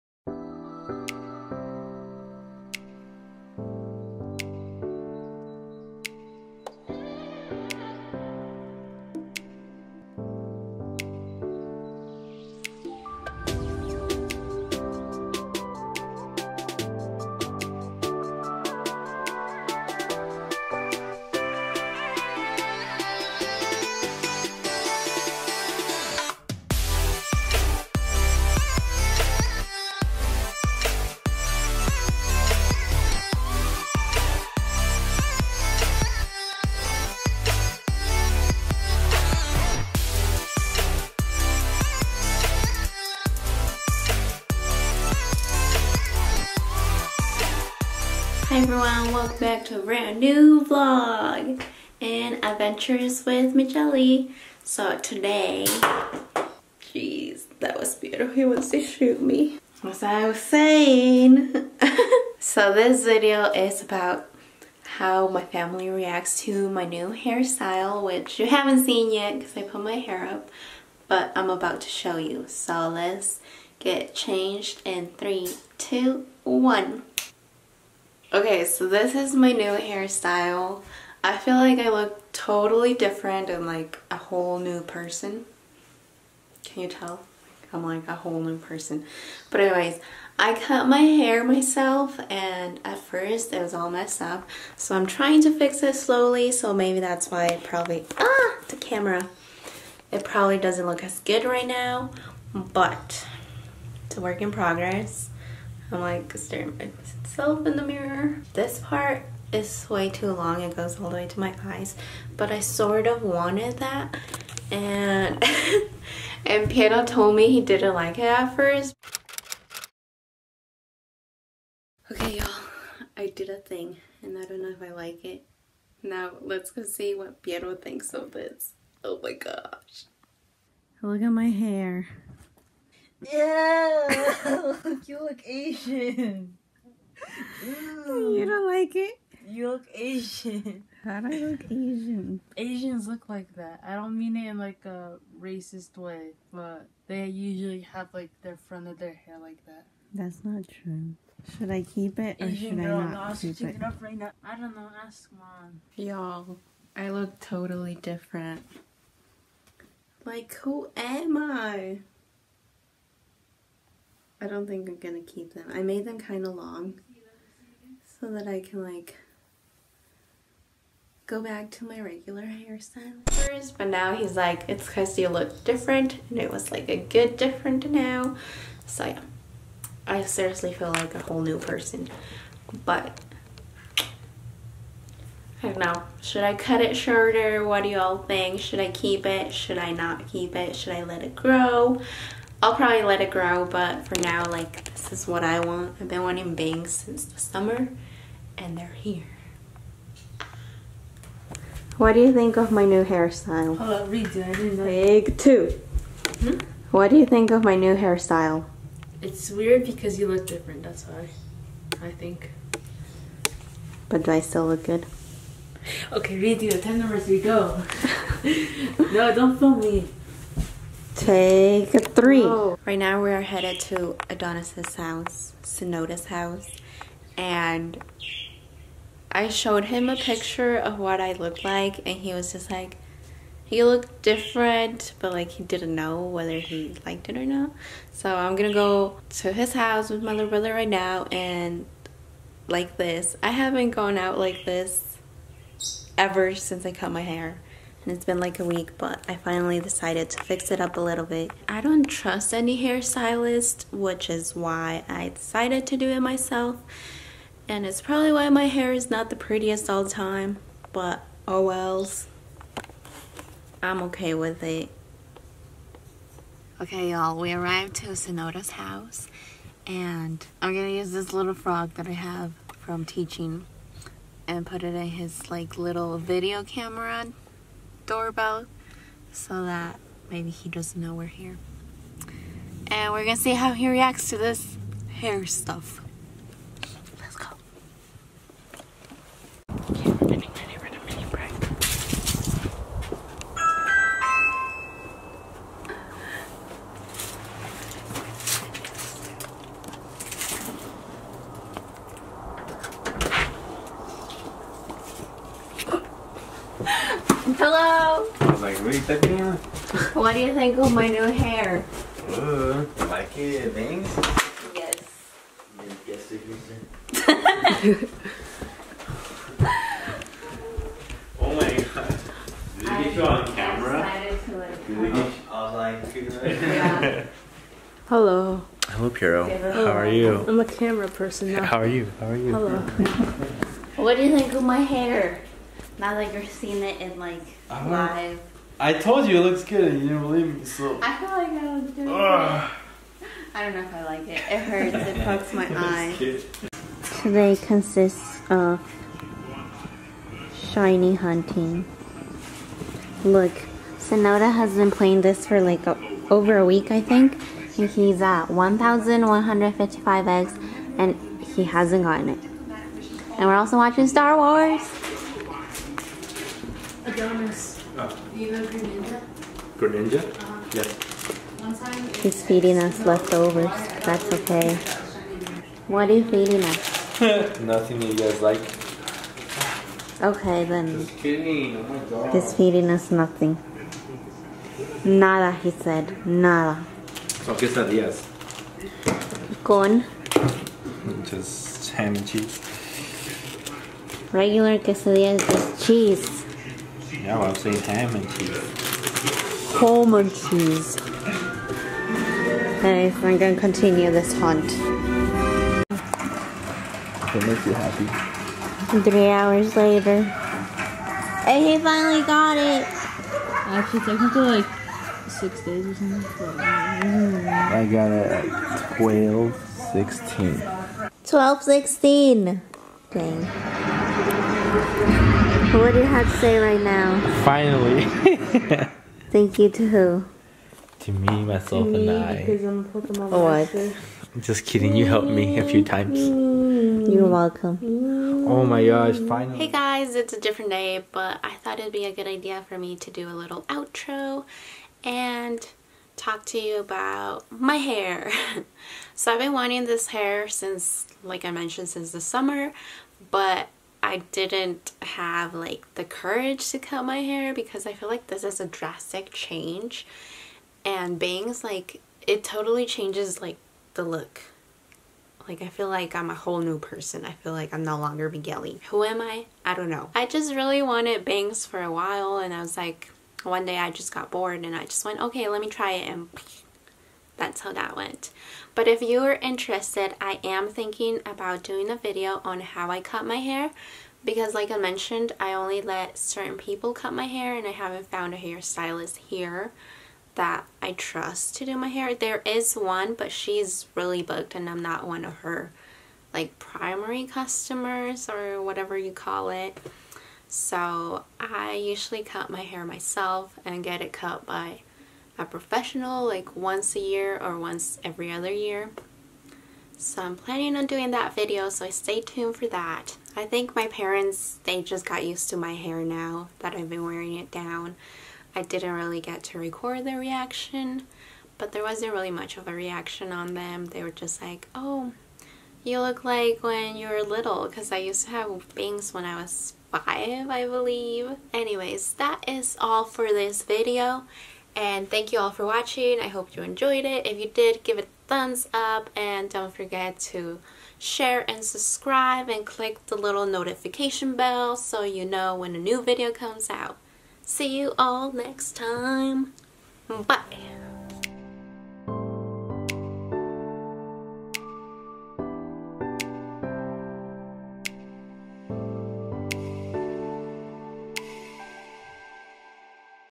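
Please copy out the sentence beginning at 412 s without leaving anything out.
Actually, technically, like six days or something.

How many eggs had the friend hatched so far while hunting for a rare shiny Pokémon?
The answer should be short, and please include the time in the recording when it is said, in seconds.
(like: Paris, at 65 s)
1,155, at 358 s.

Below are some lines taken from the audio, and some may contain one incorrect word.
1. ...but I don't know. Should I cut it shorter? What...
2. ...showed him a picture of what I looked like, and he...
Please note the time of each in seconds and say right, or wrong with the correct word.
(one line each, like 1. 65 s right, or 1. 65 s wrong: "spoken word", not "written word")
1. 182 s right
2. 229 s right.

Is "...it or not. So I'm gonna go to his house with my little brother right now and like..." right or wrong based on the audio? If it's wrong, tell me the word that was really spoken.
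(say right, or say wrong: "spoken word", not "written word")
right.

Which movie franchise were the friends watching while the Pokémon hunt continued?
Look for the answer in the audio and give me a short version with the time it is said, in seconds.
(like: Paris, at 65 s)
Star Wars, at 364 s.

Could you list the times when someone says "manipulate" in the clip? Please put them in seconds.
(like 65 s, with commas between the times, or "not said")
not said.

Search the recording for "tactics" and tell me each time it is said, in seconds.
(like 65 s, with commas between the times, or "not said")
not said.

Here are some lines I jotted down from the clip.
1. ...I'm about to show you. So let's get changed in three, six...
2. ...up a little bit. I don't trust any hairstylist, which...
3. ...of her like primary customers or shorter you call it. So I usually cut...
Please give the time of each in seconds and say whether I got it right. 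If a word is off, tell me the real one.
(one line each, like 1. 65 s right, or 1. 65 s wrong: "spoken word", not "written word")
1. 71 s wrong: "two", not "six"
2. 250 s right
3. 495 s wrong: "whatever", not "shorter".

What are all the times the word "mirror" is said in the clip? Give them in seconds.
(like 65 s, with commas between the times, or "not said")
107 s.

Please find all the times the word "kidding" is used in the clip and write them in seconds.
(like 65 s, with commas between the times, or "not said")
381 s, 434 s.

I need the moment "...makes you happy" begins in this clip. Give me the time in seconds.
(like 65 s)
407 s.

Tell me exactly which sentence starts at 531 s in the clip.
Anyways, that is all for this video.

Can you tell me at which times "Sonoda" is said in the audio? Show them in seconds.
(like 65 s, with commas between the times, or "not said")
225 s, 268 s, 353 s.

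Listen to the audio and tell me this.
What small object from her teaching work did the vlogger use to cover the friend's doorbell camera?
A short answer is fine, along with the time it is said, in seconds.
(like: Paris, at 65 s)
frog, at 271 s.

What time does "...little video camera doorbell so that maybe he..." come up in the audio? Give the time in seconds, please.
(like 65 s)
275 s.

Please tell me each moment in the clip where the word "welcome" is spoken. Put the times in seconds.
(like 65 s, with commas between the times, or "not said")
49 s, 437 s.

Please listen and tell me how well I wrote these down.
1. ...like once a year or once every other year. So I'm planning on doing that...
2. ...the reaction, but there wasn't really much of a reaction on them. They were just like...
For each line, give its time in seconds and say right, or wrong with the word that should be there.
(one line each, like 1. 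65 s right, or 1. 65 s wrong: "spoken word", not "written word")
1. 506 s right
2. 520 s right.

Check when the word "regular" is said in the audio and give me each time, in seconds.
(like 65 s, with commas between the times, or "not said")
172 s, 394 s.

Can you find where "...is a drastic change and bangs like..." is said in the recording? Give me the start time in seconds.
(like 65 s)
458 s.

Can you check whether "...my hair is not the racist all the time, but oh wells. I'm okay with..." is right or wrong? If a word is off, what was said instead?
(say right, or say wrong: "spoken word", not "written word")
wrong: "prettiest", not "racist".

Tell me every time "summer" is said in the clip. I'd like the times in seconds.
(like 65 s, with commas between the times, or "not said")
197 s, 452 s.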